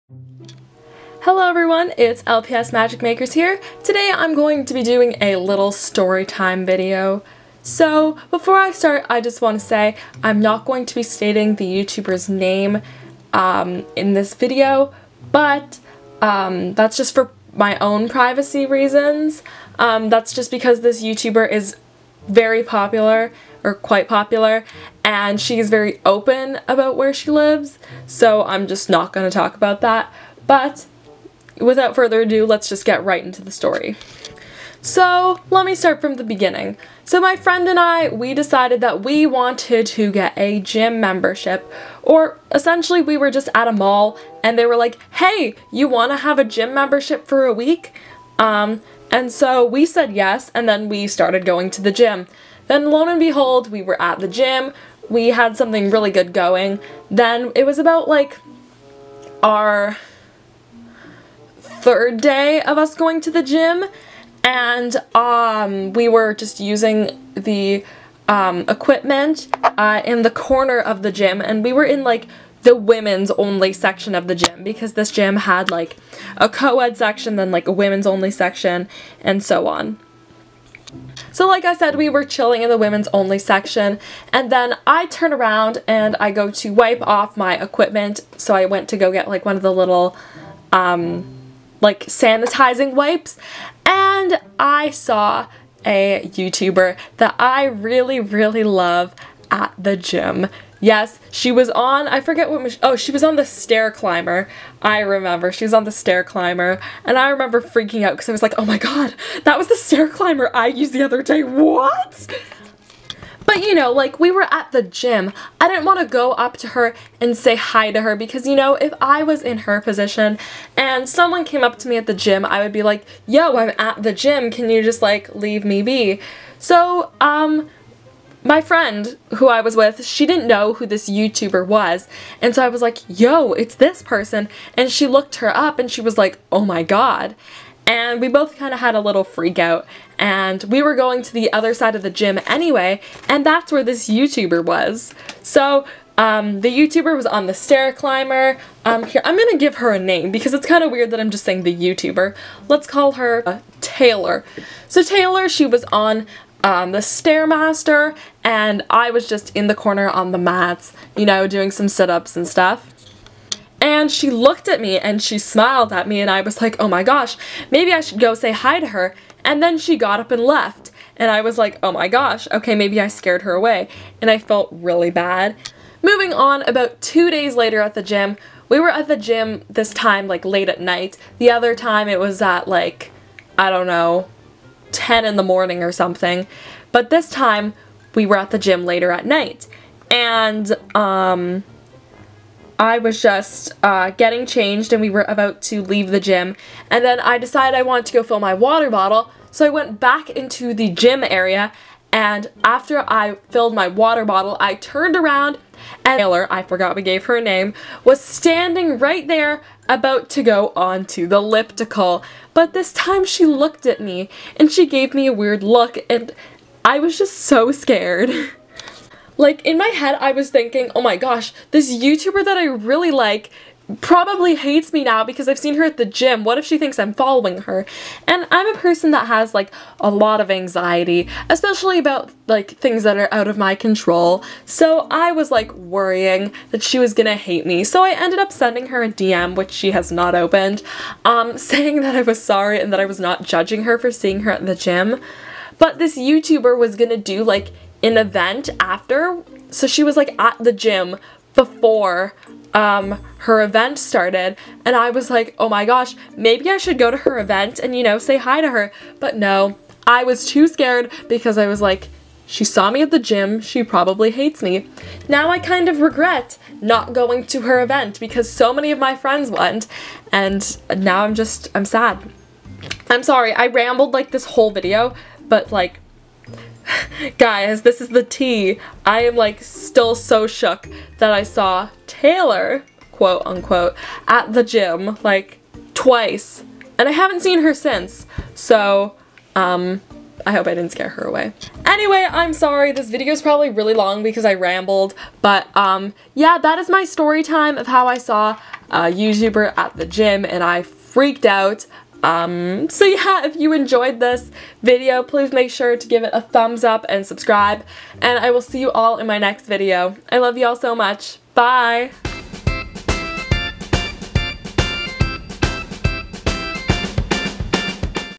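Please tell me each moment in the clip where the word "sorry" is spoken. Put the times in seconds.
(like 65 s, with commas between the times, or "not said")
242 s, 273 s, 292 s.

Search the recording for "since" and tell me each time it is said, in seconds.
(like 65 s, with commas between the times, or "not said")
287 s.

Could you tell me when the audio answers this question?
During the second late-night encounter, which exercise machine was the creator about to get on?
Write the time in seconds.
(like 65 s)
211 s.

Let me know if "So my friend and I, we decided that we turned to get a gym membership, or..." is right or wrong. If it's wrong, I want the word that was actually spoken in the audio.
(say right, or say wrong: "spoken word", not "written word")
wrong: "wanted", not "turned".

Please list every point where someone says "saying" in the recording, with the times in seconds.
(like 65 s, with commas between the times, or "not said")
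151 s, 241 s.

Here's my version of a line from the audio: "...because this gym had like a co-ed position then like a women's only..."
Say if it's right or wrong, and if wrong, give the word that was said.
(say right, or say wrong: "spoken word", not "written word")
wrong: "section", not "position".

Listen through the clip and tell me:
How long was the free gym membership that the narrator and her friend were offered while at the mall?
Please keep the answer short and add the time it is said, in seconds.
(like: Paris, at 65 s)
A week, at 47 s.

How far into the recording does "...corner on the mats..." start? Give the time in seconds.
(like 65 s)
159 s.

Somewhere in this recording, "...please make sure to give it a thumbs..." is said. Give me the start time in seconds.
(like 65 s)
305 s.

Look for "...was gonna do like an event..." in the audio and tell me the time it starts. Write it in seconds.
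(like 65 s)
246 s.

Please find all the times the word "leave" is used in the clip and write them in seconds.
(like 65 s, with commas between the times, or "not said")
125 s, 195 s.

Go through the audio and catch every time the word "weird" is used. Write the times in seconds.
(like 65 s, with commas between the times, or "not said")
150 s, 215 s.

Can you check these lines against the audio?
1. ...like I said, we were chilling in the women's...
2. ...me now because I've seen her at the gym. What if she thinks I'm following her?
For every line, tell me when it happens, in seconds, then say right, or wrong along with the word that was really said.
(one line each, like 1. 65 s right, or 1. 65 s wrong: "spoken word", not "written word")
1. 81 s right
2. 224 s right.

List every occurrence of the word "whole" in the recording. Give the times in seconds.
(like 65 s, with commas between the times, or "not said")
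274 s.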